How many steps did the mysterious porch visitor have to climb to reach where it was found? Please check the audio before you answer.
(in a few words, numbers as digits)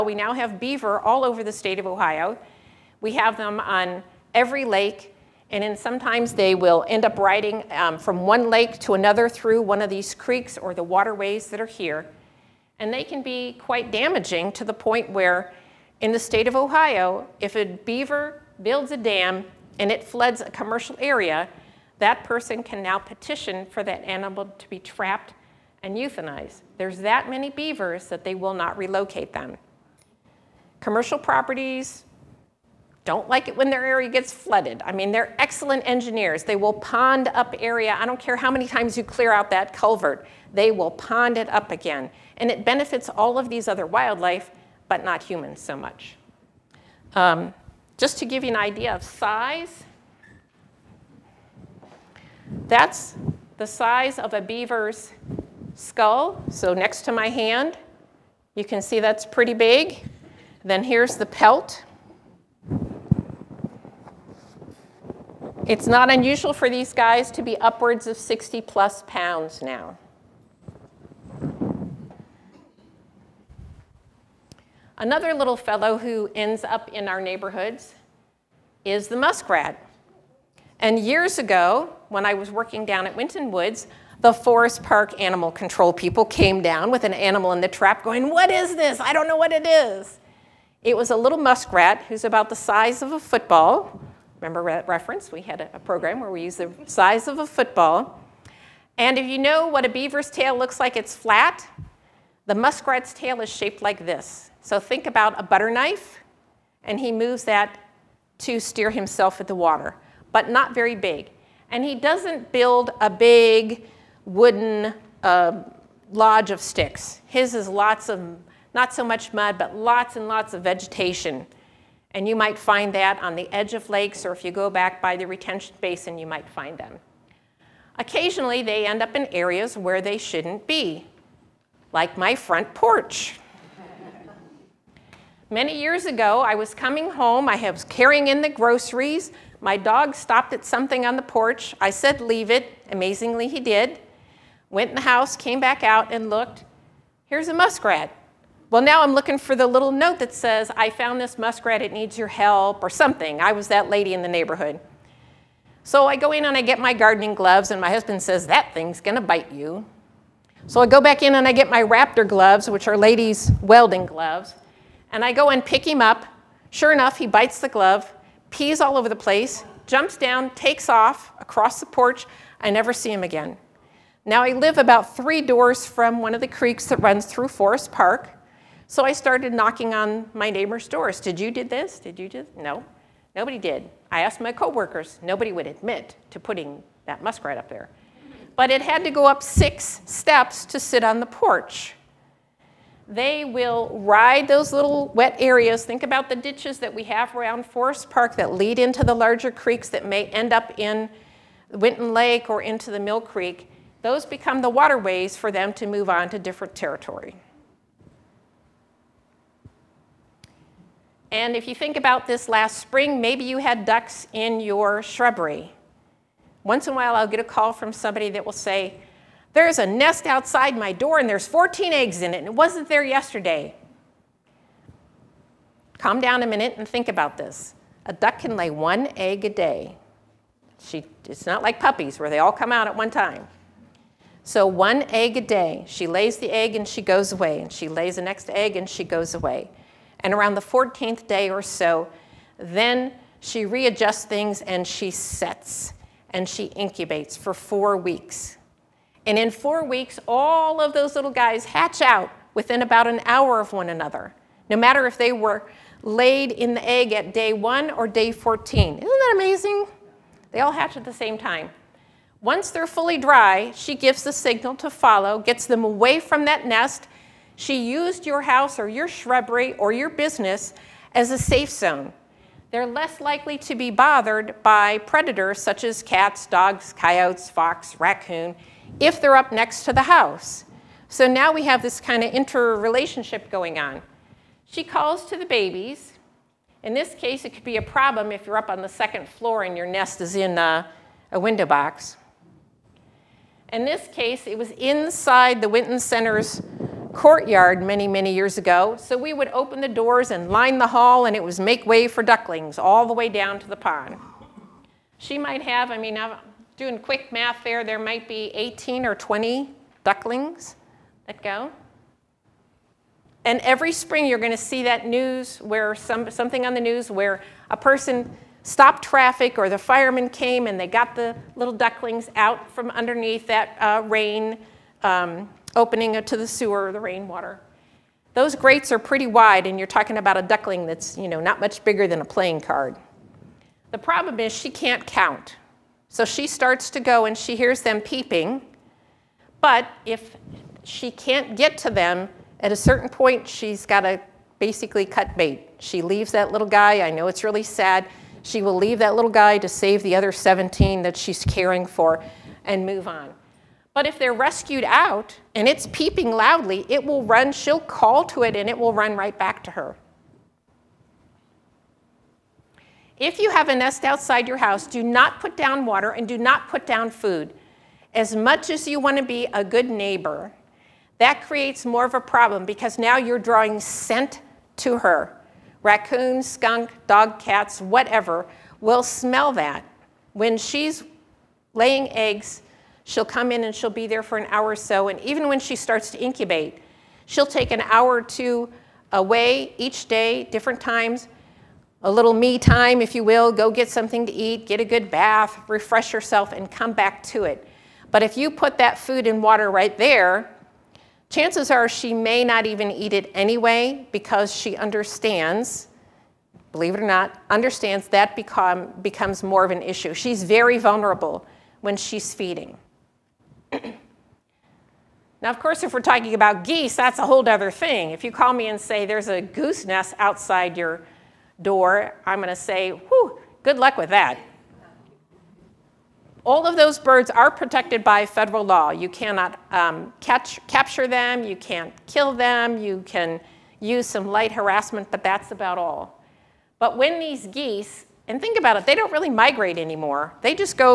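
Six.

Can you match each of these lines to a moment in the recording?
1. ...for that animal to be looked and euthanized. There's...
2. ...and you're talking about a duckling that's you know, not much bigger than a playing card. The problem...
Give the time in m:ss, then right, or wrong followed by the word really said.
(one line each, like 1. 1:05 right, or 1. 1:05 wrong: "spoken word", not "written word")
1. 0:23 wrong: "trapped", not "looked"
2. 5:29 right.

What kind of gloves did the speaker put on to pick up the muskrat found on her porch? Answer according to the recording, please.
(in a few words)
Raptor gloves.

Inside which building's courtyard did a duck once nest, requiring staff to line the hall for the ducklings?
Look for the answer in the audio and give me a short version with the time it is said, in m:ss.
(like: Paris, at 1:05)
Winton Center, at 4:55.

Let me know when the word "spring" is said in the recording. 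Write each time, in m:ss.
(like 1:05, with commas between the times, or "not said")
3:32, 5:13.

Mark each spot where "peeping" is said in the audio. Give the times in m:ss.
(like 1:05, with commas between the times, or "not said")
5:38, 5:55.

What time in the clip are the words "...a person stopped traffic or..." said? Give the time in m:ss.
5:17.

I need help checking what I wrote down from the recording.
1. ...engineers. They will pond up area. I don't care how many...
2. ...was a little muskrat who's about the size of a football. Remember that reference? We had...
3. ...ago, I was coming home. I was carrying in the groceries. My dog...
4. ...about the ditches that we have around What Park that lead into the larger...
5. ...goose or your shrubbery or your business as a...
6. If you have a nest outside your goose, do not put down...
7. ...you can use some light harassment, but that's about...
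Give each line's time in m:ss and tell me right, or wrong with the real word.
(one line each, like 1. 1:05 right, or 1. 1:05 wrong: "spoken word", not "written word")
1. 0:35 right
2. 1:30 right
3. 2:16 right
4. 3:16 wrong: "Forest", not "What"
5. 4:28 wrong: "house", not "goose"
6. 6:03 wrong: "house", not "goose"
7. 7:12 right.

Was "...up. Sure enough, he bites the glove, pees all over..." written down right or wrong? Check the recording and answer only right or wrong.
right.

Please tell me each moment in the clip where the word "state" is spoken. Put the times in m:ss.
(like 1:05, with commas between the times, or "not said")
0:01, 0:16.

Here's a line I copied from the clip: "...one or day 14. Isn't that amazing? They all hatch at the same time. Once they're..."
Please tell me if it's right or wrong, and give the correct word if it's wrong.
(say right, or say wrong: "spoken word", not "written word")
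right.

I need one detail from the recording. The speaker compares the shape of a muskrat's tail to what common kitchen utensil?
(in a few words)
A butter knife.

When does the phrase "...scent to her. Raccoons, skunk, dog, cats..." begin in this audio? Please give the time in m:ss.
6:13.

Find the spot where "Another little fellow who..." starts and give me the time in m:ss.
1:15.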